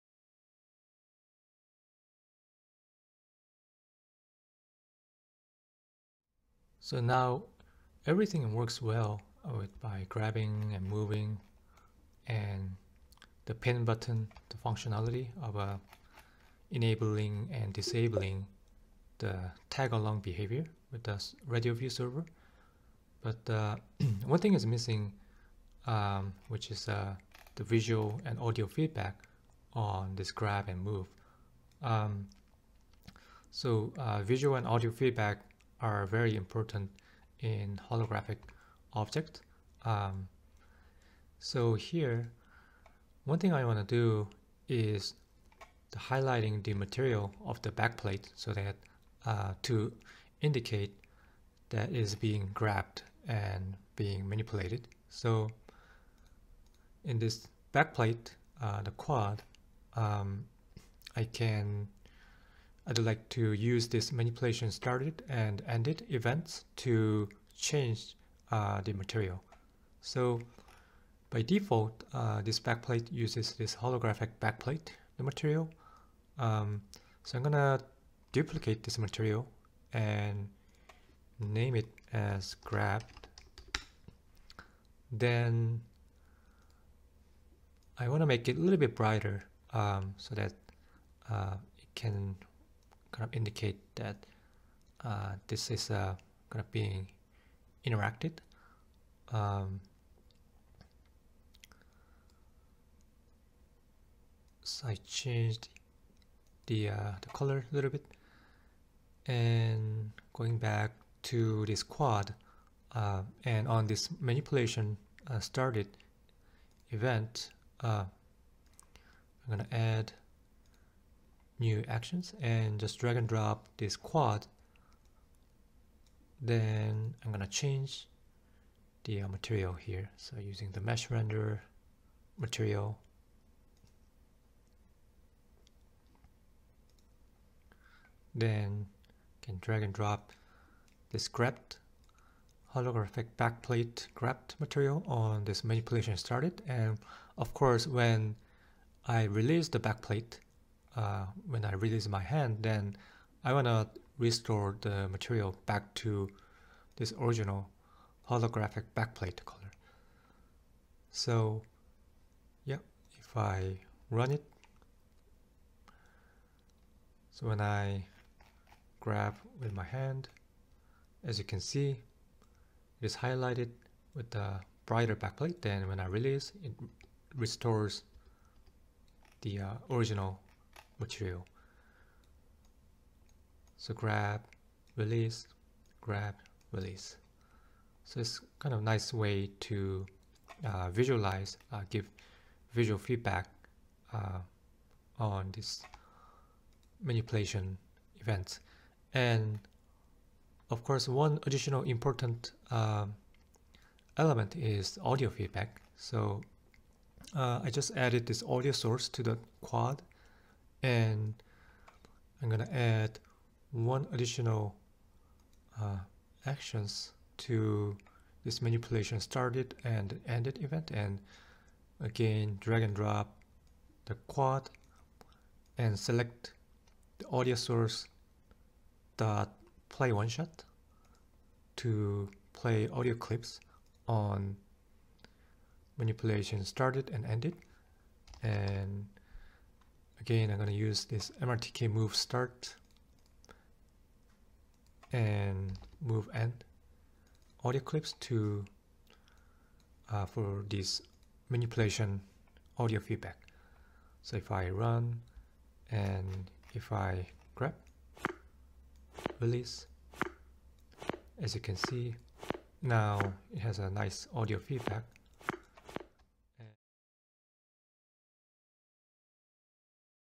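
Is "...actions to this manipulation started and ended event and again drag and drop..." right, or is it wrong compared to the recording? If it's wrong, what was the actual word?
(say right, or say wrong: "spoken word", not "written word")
right.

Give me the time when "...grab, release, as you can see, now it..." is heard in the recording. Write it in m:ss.
4:17.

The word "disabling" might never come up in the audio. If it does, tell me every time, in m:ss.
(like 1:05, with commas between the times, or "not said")
0:17.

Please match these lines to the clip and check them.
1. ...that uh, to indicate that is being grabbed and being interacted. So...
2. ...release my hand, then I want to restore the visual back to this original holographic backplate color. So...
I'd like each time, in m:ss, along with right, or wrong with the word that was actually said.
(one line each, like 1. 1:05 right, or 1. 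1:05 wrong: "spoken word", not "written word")
1. 0:48 wrong: "manipulated", not "interacted"
2. 2:31 wrong: "material", not "visual".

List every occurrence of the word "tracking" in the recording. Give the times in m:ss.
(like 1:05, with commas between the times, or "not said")
not said.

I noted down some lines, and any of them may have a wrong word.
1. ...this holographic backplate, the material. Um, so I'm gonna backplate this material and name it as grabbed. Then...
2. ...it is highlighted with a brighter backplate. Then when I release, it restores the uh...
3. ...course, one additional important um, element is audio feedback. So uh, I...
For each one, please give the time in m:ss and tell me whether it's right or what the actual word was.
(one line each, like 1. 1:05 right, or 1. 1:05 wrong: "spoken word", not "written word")
1. 1:13 wrong: "duplicate", not "backplate"
2. 2:53 right
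3. 3:20 right.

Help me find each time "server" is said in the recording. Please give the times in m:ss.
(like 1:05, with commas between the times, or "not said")
0:21.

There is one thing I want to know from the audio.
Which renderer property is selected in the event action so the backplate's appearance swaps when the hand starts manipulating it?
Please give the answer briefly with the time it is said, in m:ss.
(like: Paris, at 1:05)
mesh render material, at 2:10.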